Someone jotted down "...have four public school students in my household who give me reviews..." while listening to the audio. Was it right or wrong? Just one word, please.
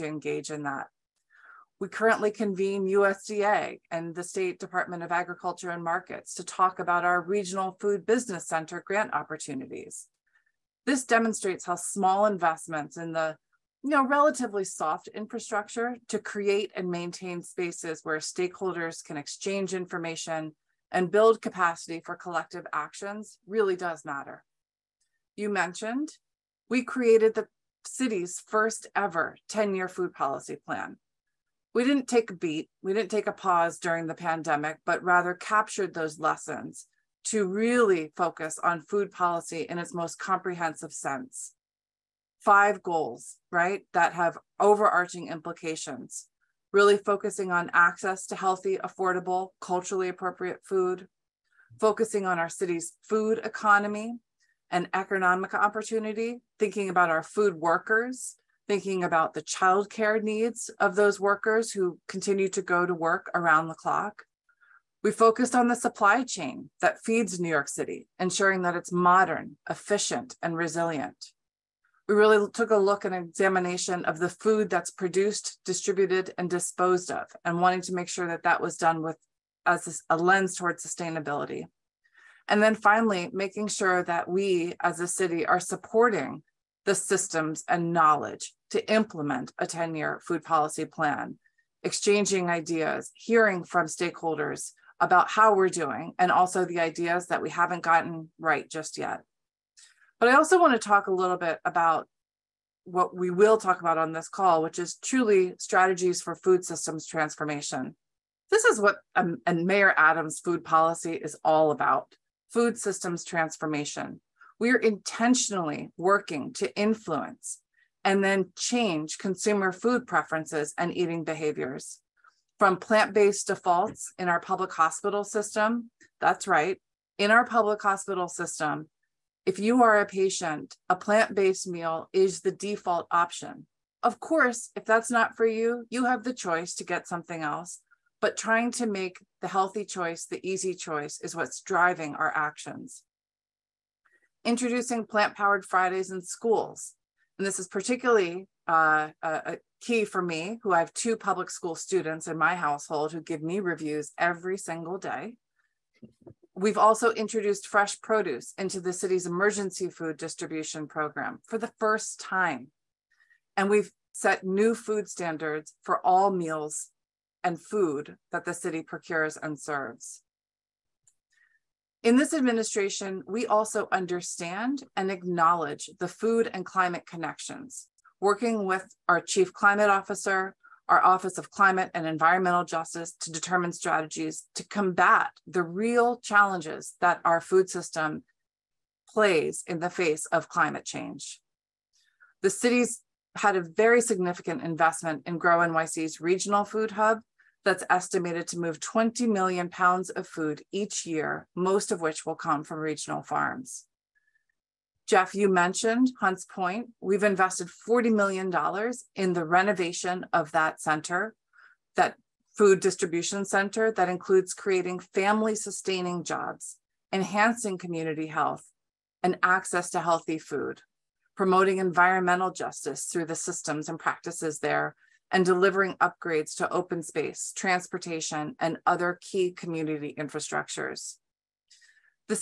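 wrong.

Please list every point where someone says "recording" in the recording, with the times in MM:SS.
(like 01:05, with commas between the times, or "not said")
not said.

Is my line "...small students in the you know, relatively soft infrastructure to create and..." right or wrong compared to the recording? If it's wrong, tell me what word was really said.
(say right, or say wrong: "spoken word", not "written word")
wrong: "investments", not "students".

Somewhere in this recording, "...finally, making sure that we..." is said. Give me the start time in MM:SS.
01:22.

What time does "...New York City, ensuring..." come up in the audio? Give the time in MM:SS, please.
01:07.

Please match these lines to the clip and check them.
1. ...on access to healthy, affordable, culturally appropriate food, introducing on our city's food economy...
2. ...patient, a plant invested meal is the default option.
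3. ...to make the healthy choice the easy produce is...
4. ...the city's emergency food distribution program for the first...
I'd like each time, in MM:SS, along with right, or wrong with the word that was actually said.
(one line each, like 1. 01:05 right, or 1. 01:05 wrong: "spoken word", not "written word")
1. 00:47 wrong: "focusing", not "introducing"
2. 02:10 wrong: "based", not "invested"
3. 02:18 wrong: "choice", not "produce"
4. 02:38 right.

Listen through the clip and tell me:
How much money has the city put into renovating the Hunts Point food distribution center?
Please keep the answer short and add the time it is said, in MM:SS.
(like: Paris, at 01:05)
$40 million, at 03:27.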